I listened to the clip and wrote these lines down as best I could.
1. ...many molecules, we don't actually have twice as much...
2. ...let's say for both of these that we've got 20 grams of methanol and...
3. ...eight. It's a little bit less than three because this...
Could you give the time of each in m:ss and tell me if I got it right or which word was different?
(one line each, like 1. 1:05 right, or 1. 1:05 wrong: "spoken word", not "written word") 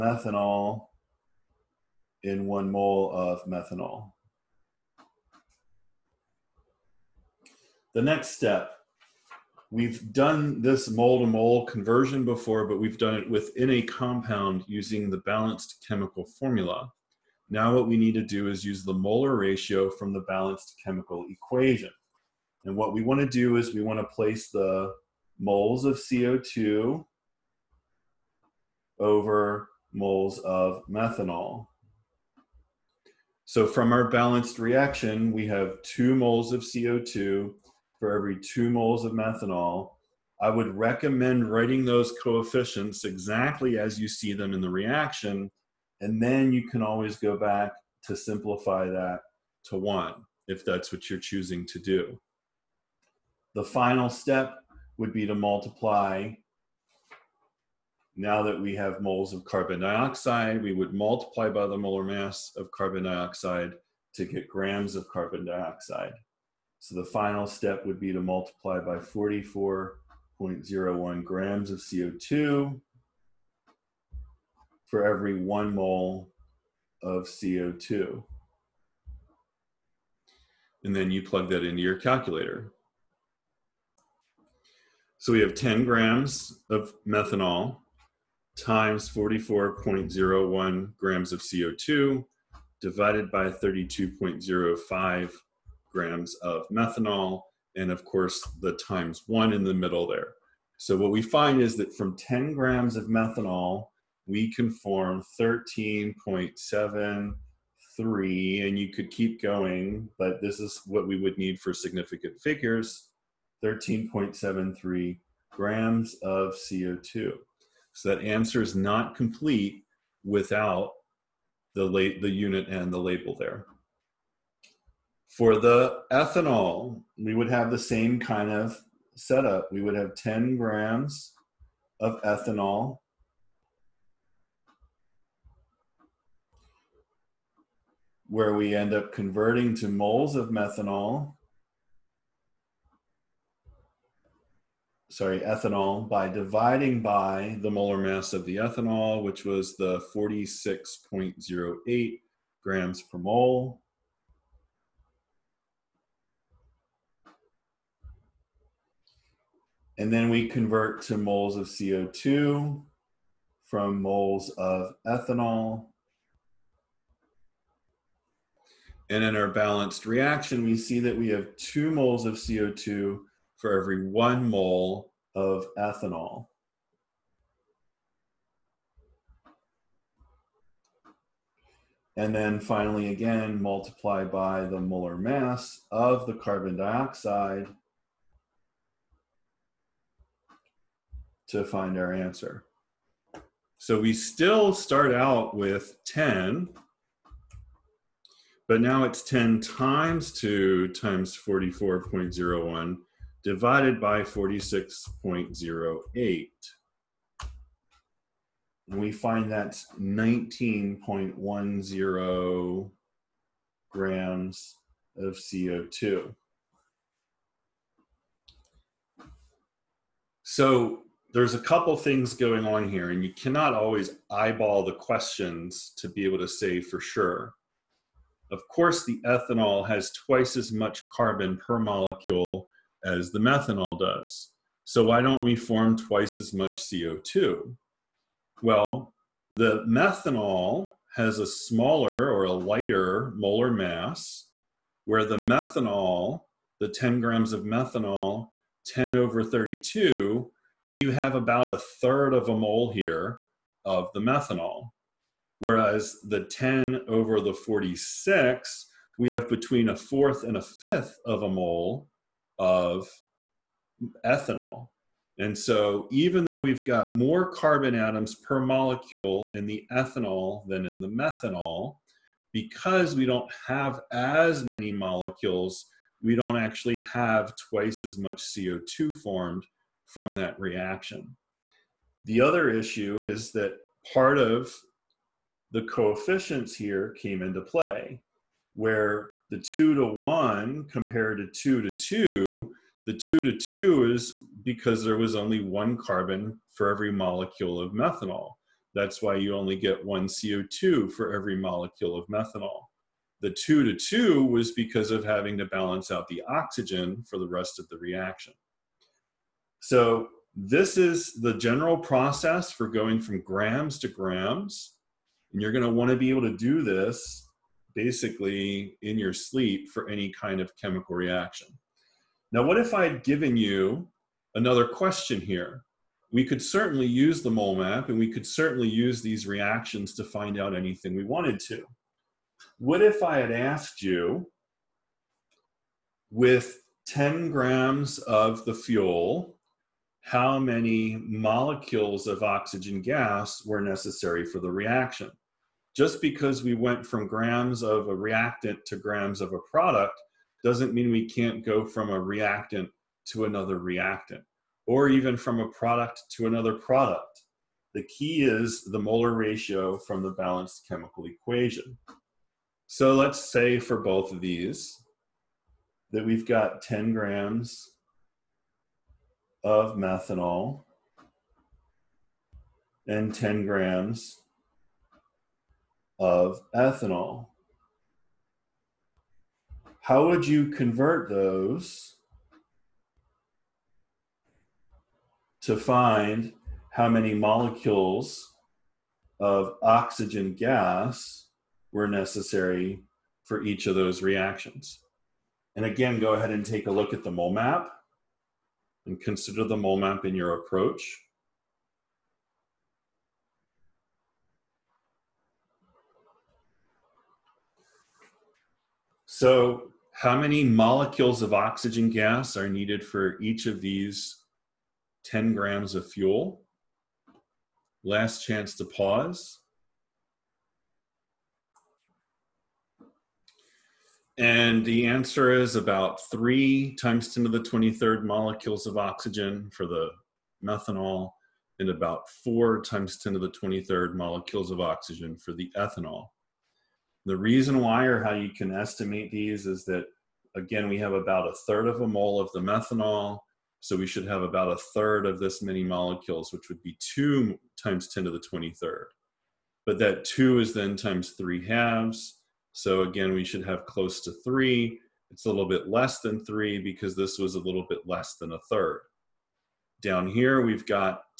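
1. 4:34 right
2. 6:03 wrong: "10", not "20"
3. 7:34 wrong: "three", not "eight".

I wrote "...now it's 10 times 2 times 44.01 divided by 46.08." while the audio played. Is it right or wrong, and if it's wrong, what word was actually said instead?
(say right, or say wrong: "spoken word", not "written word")
right.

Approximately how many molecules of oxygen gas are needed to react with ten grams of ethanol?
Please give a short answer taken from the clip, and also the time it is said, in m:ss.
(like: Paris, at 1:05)
4 × 10^23, at 7:12.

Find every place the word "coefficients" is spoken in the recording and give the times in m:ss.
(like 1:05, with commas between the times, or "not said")
0:42, 4:45.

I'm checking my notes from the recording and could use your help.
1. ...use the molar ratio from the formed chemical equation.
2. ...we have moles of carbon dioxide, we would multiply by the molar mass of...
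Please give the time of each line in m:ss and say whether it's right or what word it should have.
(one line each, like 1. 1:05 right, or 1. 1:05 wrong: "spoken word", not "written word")
1. 0:18 wrong: "balanced", not "formed"
2. 0:58 right.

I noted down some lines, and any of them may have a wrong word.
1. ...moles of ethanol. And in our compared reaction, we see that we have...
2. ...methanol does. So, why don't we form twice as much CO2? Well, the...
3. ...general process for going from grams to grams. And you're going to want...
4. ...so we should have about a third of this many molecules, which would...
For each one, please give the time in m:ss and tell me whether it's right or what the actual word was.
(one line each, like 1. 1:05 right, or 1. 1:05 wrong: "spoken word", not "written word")
1. 2:44 wrong: "balanced", not "compared"
2. 3:53 right
3. 5:11 right
4. 7:23 right.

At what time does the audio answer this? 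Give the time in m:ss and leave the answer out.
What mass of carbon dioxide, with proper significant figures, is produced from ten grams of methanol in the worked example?
1:53.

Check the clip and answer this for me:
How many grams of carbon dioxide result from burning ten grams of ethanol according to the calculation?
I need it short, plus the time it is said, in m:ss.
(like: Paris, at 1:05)
19.10 grams, at 3:29.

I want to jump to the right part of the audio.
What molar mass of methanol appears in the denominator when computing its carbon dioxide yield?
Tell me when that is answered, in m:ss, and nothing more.
1:33.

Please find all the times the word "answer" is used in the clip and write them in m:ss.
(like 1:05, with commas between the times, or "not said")
1:58, 3:12, 7:05.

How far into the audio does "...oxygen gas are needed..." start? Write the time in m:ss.
6:51.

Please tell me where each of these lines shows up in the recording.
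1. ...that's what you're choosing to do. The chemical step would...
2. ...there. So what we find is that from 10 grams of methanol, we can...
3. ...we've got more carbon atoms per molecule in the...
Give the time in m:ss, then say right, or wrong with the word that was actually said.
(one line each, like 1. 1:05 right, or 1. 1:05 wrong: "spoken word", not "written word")
1. 0:50 wrong: "final", not "chemical"
2. 1:40 right
3. 4:26 right.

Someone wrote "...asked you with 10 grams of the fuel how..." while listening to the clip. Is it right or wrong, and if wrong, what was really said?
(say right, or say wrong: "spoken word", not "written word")
right.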